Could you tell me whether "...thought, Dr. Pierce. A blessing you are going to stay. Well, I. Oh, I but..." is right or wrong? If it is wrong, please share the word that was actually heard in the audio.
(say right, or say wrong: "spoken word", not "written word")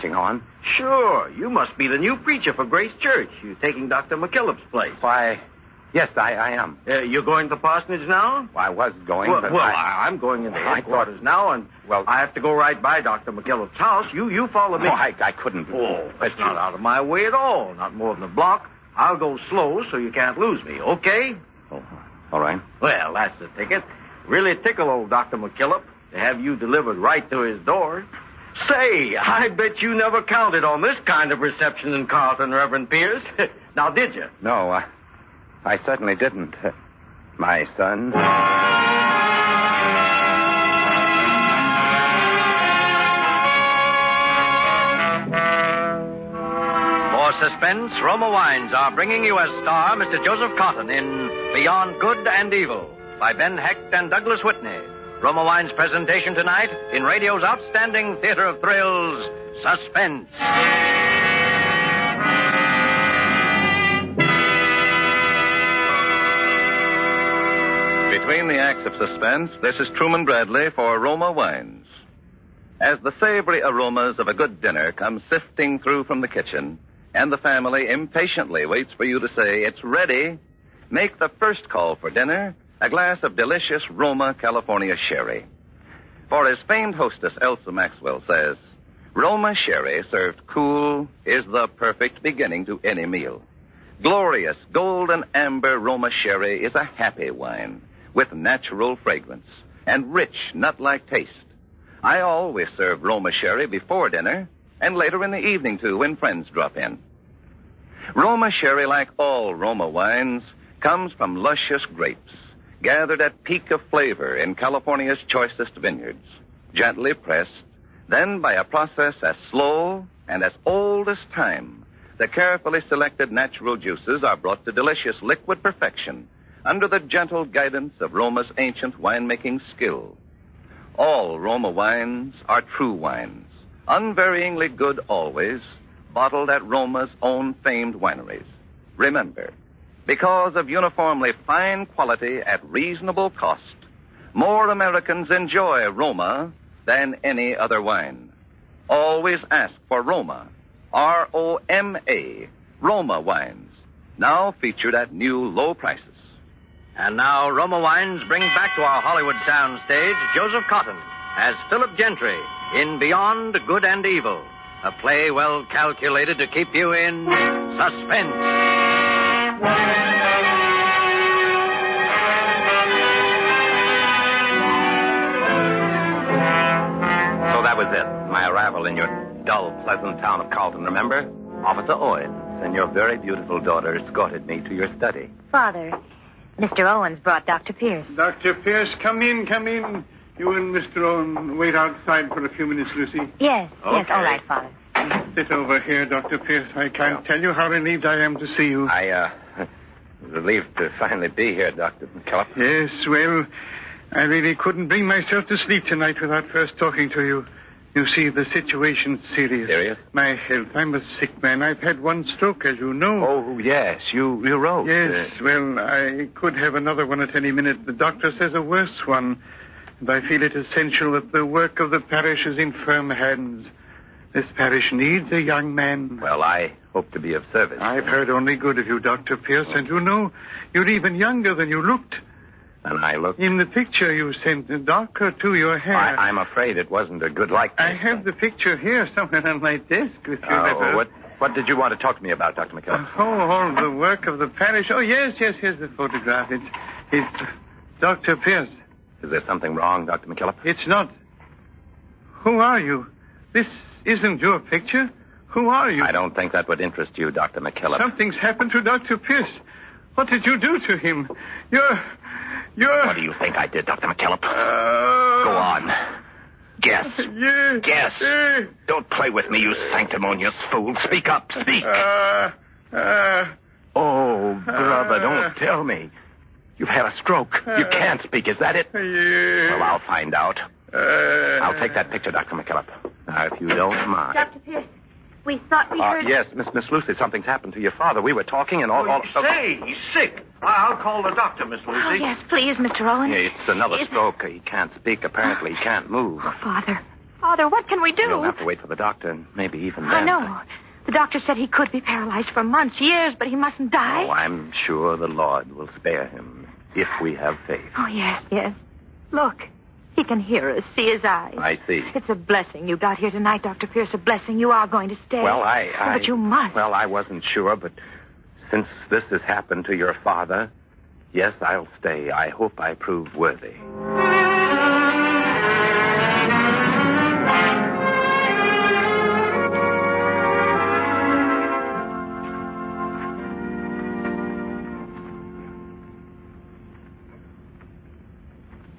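wrong: "tonight", not "thought".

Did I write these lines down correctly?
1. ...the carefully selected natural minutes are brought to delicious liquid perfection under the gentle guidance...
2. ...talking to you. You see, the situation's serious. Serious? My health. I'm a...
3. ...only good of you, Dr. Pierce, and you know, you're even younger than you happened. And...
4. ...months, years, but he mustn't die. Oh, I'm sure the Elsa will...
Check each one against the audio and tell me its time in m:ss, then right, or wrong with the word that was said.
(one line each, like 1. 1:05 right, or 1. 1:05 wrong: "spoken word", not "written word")
1. 2:02 wrong: "juices", not "minutes"
2. 3:26 right
3. 3:48 wrong: "looked", not "happened"
4. 5:02 wrong: "Lord", not "Elsa".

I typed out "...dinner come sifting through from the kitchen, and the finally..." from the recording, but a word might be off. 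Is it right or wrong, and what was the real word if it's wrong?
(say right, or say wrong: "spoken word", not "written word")
wrong: "family", not "finally".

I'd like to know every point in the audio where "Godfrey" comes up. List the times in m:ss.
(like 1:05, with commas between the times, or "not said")
not said.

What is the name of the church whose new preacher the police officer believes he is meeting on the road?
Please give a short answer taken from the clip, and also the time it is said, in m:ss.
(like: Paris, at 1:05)
Grace Church, at 0:02.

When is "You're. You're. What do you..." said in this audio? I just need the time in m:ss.
4:21.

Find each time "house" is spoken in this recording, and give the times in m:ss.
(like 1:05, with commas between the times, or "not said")
0:13.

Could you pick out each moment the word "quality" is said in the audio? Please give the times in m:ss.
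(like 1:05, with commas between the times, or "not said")
2:21.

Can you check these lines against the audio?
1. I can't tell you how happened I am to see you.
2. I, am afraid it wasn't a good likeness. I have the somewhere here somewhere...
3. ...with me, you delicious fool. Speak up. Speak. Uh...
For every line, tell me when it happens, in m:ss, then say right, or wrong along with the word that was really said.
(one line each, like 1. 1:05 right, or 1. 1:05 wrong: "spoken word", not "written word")
1. 3:16 wrong: "relieved", not "happened"
2. 3:55 wrong: "picture", not "somewhere"
3. 4:29 wrong: "sanctimonious", not "delicious".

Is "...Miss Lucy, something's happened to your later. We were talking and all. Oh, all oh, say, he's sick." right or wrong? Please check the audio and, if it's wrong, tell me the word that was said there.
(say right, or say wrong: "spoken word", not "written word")
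wrong: "father", not "later".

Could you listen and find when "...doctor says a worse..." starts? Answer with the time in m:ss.
3:37.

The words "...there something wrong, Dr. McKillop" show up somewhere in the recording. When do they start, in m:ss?
4:09.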